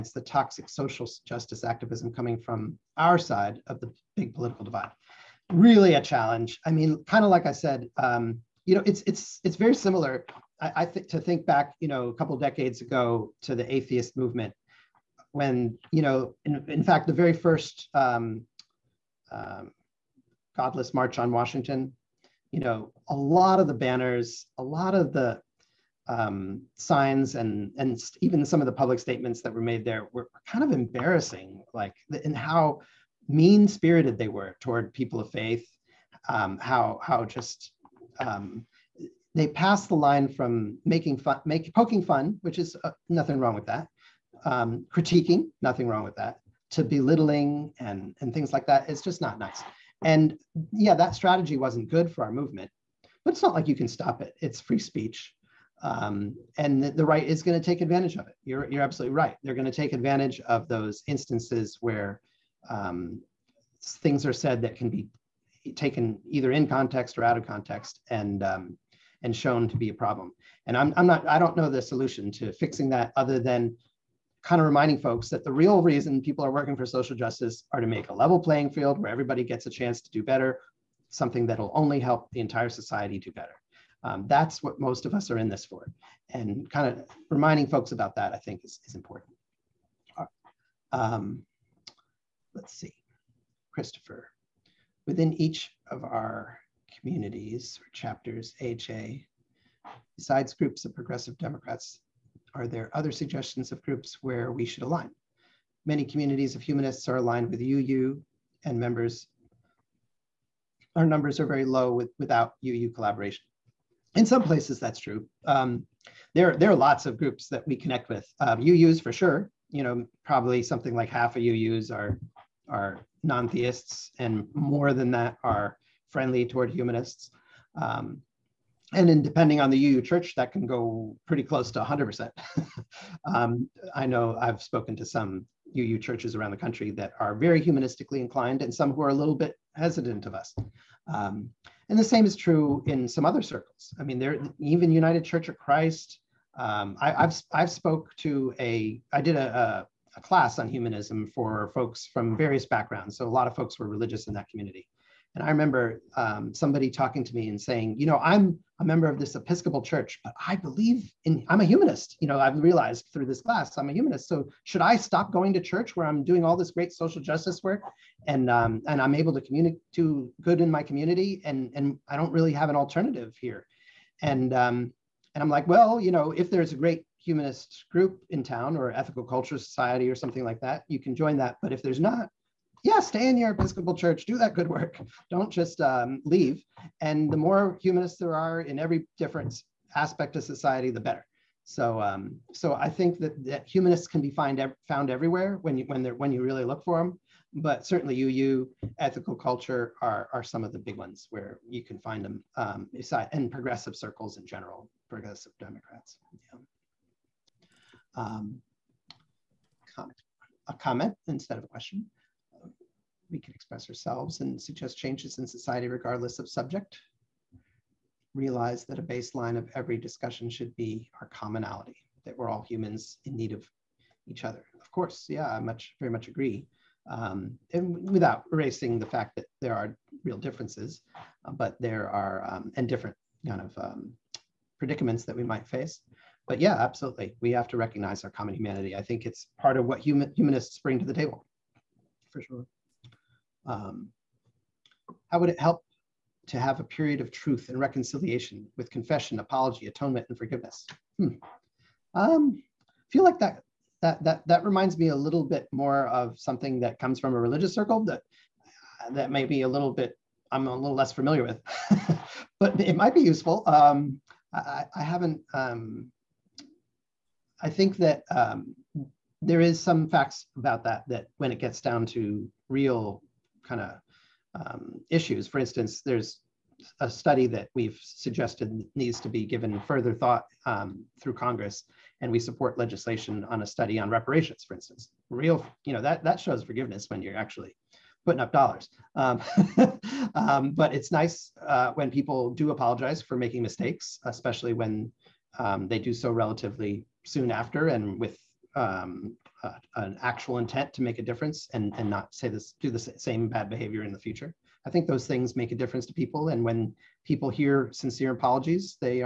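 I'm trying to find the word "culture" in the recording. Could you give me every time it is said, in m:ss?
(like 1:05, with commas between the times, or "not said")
2:59, 3:19.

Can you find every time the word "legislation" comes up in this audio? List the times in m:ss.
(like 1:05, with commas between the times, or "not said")
4:42.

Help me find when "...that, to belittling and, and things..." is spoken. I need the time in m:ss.
0:46.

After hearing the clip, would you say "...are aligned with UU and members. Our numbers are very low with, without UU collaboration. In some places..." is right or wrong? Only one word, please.
right.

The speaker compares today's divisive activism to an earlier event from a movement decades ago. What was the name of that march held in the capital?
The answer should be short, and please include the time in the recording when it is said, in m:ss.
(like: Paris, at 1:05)
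Godless March on Washington, at 0:20.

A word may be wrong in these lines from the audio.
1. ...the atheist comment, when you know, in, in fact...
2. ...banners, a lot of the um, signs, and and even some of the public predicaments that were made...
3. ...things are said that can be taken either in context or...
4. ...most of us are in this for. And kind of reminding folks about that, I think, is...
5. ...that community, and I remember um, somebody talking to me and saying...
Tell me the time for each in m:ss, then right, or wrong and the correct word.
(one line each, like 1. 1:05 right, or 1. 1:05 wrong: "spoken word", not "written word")
1. 0:13 wrong: "movement", not "comment"
2. 0:23 wrong: "statements", not "predicaments"
3. 1:03 right
4. 1:24 right
5. 2:34 right.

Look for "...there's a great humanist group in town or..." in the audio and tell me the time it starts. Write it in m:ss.
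2:56.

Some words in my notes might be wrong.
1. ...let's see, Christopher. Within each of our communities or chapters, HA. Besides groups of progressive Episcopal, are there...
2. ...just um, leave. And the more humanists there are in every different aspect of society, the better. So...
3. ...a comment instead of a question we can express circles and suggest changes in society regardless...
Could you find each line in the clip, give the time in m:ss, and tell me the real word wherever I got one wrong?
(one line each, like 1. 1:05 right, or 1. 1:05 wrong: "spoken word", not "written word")
1. 1:32 wrong: "Democrats", not "Episcopal"
2. 3:05 right
3. 3:30 wrong: "ourselves", not "circles".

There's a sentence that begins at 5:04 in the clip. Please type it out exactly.
I think those things make a difference to people.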